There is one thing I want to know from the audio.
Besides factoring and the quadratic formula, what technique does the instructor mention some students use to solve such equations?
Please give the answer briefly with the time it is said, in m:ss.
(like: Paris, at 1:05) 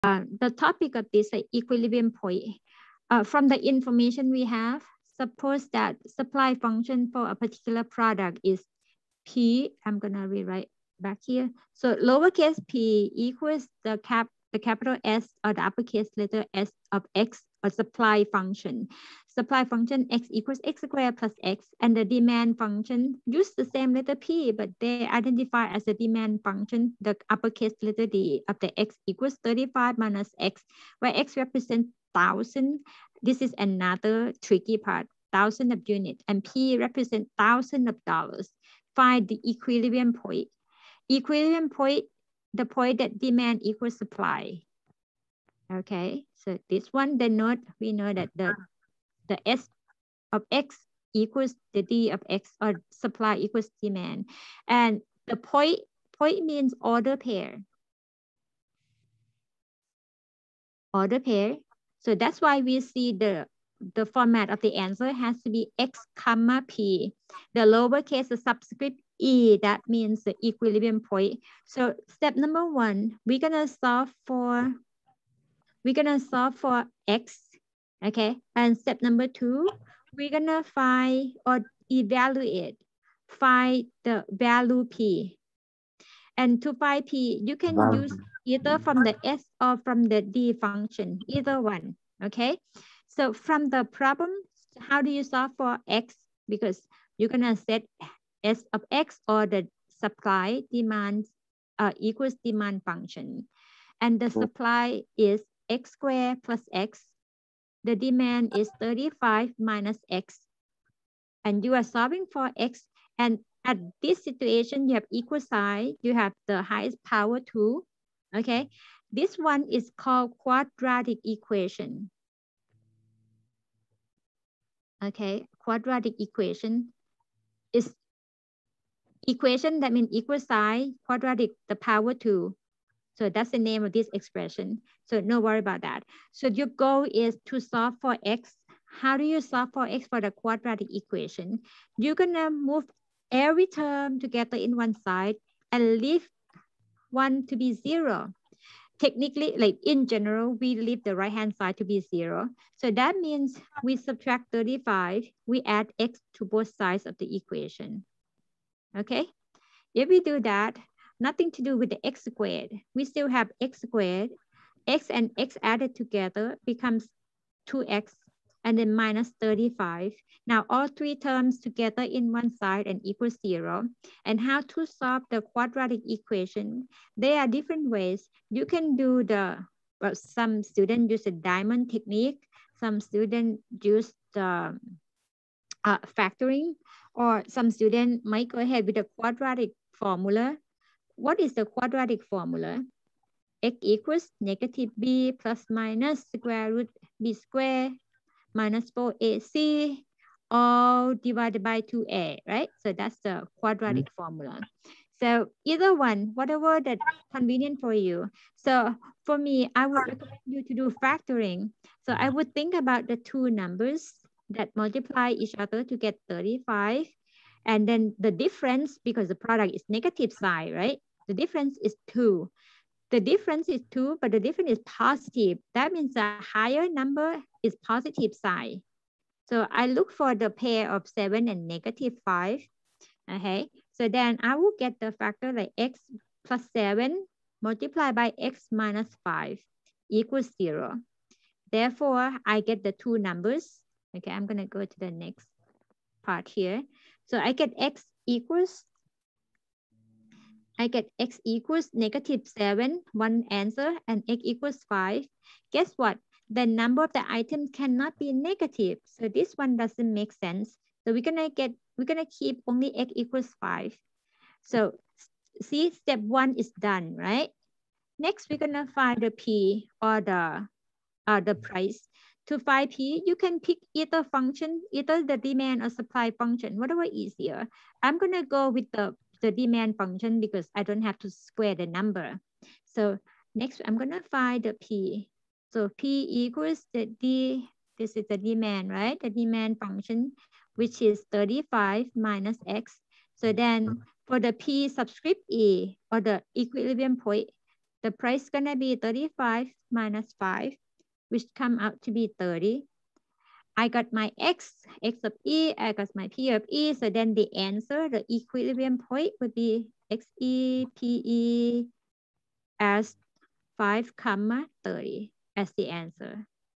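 Diamond technique, at 3:01.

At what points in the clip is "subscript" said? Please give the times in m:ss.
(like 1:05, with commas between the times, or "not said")
1:08, 4:54.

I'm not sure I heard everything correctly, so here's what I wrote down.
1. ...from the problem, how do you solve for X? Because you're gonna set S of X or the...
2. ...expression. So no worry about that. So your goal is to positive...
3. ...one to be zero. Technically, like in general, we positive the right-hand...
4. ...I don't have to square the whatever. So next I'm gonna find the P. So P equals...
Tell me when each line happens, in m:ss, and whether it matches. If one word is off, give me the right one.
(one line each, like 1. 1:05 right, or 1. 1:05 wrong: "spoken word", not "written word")
1. 1:33 right
2. 2:14 wrong: "solve", not "positive"
3. 2:27 wrong: "leave", not "positive"
4. 4:40 wrong: "number", not "whatever".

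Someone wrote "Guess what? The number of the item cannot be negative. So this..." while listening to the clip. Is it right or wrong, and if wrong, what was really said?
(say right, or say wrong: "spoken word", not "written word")
right.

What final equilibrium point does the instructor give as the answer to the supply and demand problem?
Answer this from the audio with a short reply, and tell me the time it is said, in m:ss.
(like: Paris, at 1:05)
(5, 30), at 5:13.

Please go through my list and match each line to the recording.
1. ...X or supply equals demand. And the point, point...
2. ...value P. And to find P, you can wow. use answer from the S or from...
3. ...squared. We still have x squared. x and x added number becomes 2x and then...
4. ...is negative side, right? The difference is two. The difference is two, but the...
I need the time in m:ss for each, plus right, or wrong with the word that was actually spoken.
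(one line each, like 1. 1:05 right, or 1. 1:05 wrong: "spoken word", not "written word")
1. 0:52 right
2. 1:24 wrong: "either", not "answer"
3. 2:42 wrong: "together", not "number"
4. 3:39 right.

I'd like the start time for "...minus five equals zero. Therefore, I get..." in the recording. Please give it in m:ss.
3:58.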